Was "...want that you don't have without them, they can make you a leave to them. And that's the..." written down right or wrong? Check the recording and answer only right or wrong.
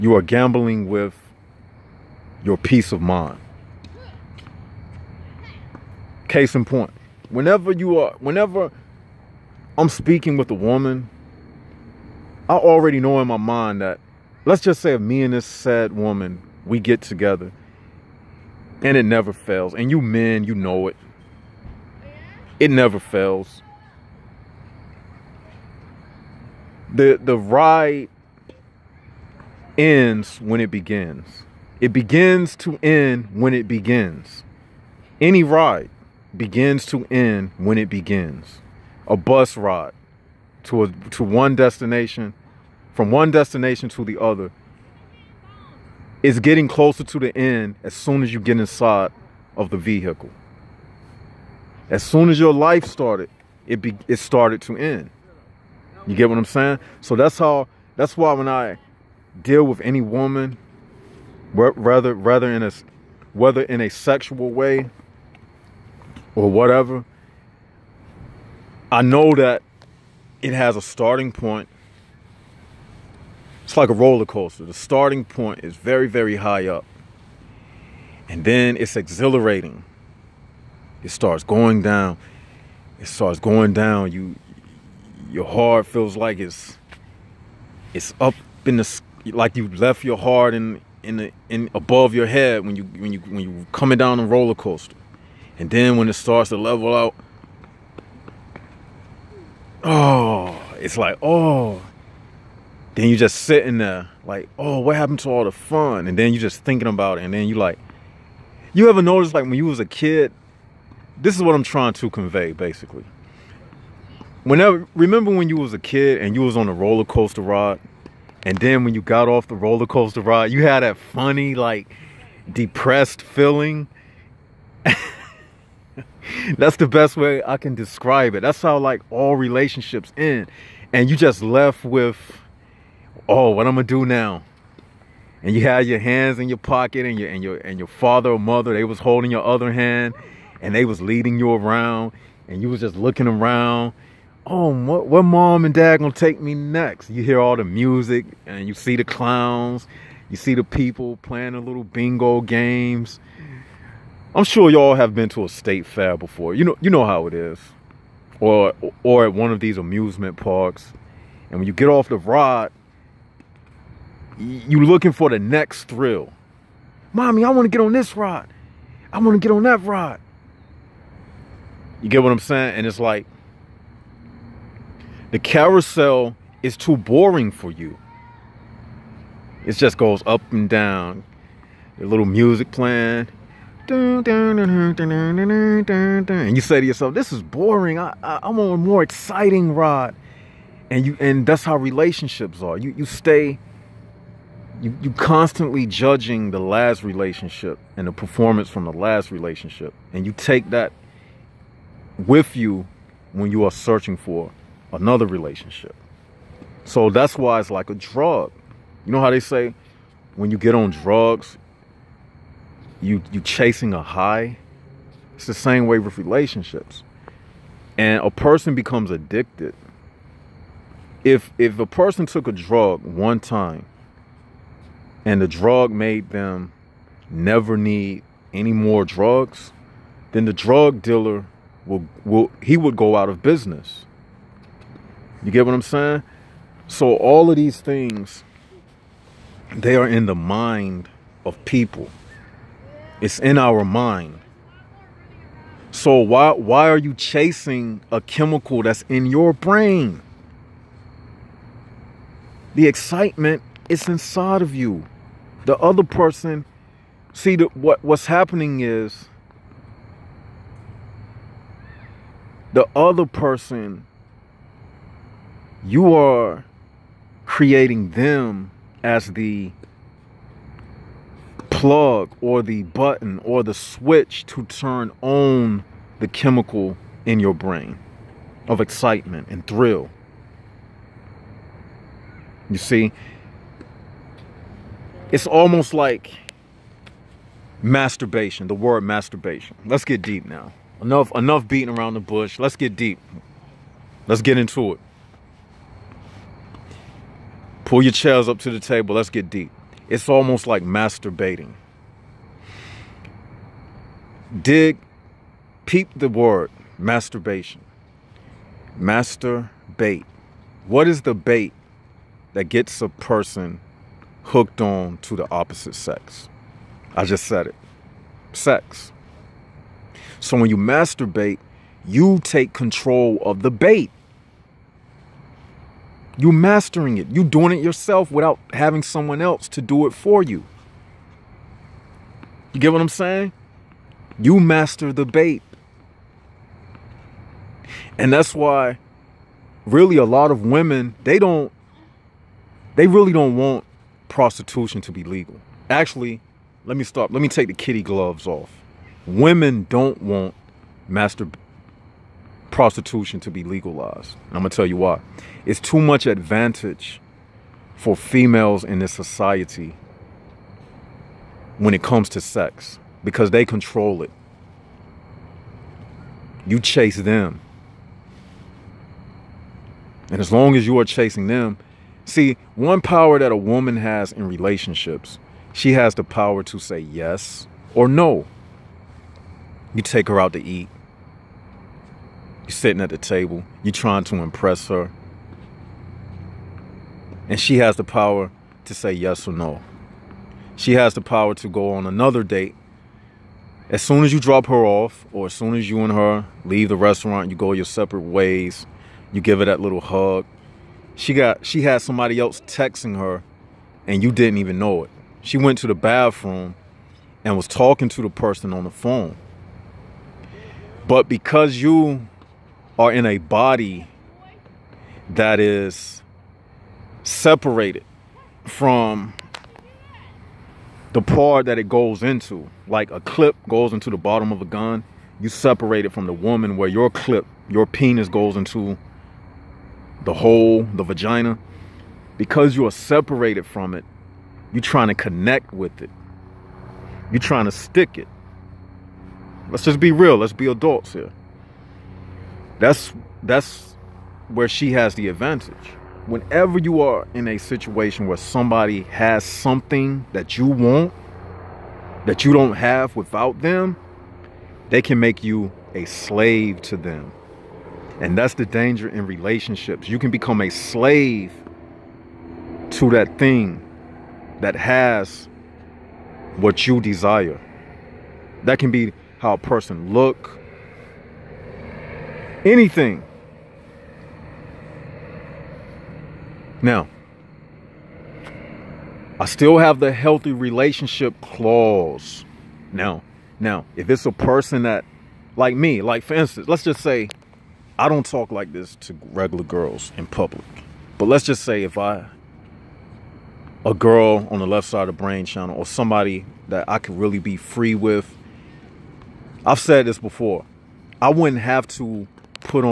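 wrong.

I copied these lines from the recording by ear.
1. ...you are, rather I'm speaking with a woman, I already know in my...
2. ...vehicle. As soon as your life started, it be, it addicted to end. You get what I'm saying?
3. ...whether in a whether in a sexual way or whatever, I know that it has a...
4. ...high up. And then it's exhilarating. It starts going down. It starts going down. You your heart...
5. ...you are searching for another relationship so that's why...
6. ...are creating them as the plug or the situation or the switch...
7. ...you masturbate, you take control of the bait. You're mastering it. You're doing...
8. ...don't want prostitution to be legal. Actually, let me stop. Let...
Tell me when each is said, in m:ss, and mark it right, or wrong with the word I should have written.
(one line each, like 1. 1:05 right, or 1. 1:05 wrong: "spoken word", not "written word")
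1. 0:07 wrong: "whenever", not "rather"
2. 0:49 wrong: "started", not "addicted"
3. 1:02 wrong: "rather", not "whether"
4. 1:16 right
5. 3:23 right
6. 4:26 wrong: "button", not "situation"
7. 5:20 right
8. 5:43 right.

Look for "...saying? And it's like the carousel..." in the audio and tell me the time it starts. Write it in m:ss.
2:52.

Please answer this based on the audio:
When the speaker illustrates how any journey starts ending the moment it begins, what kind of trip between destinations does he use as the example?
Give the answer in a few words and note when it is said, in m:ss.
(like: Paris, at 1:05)
A bus ride, at 0:39.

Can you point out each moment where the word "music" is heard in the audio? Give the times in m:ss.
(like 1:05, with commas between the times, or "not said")
2:27, 3:02.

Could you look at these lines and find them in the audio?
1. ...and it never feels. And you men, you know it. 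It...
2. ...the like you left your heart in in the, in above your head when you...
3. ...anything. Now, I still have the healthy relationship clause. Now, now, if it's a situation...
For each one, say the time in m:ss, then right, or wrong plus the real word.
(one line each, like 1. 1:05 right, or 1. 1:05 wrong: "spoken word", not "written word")
1. 0:18 wrong: "fails", not "feels"
2. 1:28 right
3. 7:52 wrong: "person", not "situation".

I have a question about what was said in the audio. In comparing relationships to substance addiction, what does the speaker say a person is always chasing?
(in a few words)
A high.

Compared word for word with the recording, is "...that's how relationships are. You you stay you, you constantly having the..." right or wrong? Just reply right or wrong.
wrong.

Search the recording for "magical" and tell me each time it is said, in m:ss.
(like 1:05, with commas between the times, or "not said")
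not said.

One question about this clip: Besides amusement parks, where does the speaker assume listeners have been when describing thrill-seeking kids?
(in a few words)
A state fair.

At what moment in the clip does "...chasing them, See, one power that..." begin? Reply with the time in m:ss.
6:11.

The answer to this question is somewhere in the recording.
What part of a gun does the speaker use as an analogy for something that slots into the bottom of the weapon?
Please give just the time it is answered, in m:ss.
7:03.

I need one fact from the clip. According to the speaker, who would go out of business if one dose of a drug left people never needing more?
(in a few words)
The drug dealer.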